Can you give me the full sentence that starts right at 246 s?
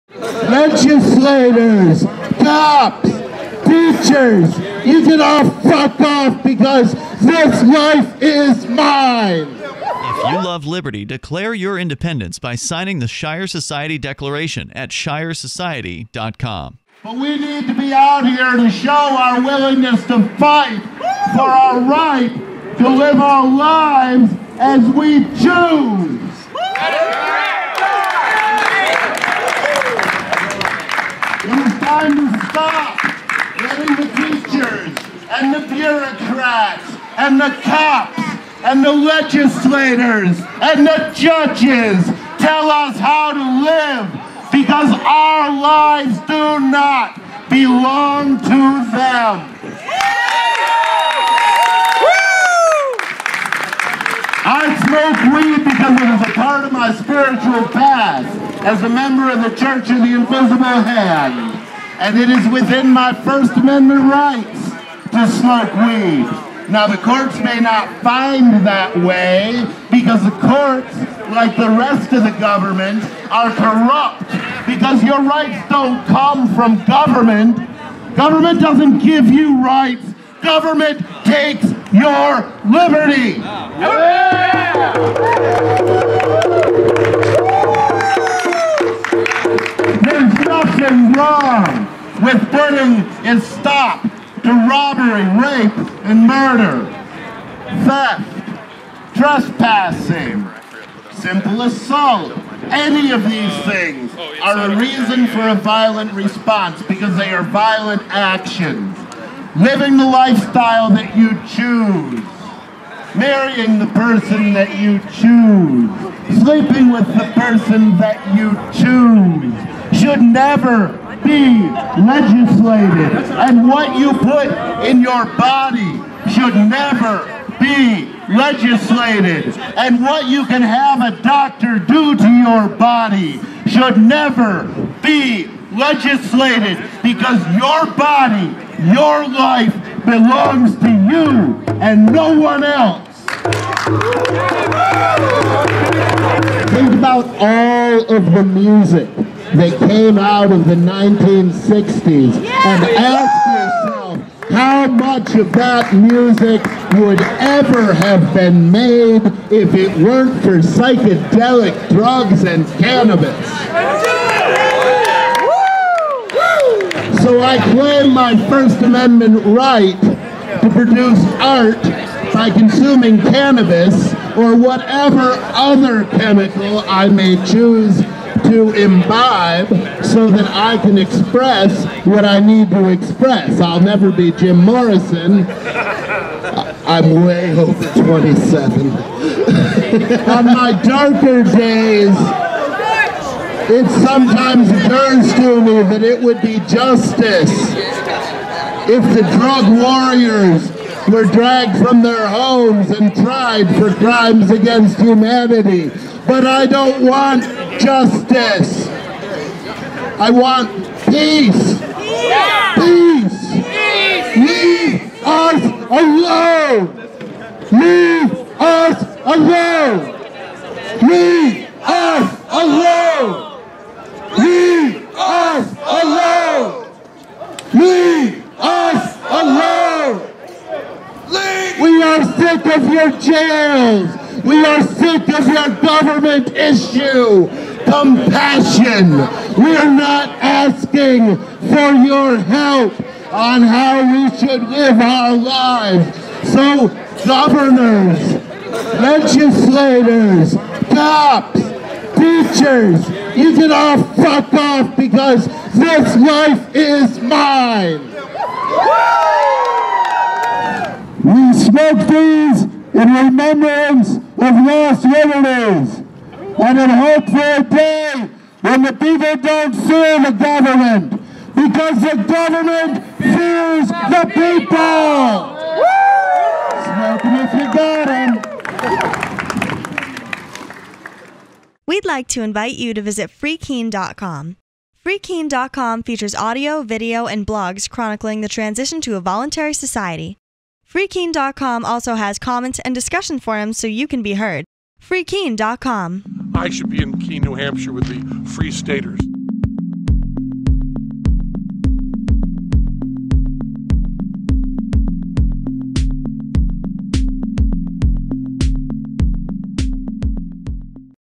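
So governors, legislators, cops, teachers, you can all fuck off because this life is mine.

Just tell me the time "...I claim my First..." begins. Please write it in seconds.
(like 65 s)
167 s.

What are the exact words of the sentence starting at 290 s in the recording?
Freekeene.com also has comments and discussion forums so you can be heard.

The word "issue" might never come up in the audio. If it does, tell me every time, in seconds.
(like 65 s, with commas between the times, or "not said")
236 s.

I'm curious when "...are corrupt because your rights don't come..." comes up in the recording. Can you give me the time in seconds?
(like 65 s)
73 s.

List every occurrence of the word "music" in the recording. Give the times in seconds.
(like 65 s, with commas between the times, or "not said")
148 s, 155 s.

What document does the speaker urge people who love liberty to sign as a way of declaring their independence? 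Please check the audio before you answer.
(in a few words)
Shire Society Declaration.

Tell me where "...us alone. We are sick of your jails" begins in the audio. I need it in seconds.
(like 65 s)
228 s.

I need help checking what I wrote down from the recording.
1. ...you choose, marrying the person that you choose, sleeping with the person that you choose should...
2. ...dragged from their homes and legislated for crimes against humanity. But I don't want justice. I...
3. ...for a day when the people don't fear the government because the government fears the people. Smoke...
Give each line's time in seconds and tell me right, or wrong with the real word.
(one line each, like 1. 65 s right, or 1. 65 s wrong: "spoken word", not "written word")
1. 111 s right
2. 201 s wrong: "tried", not "legislated"
3. 267 s right.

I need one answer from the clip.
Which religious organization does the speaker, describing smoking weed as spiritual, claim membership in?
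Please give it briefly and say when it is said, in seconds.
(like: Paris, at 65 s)
Church of the Invisible Hand, at 59 s.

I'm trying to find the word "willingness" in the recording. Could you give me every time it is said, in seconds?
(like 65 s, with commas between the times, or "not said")
19 s.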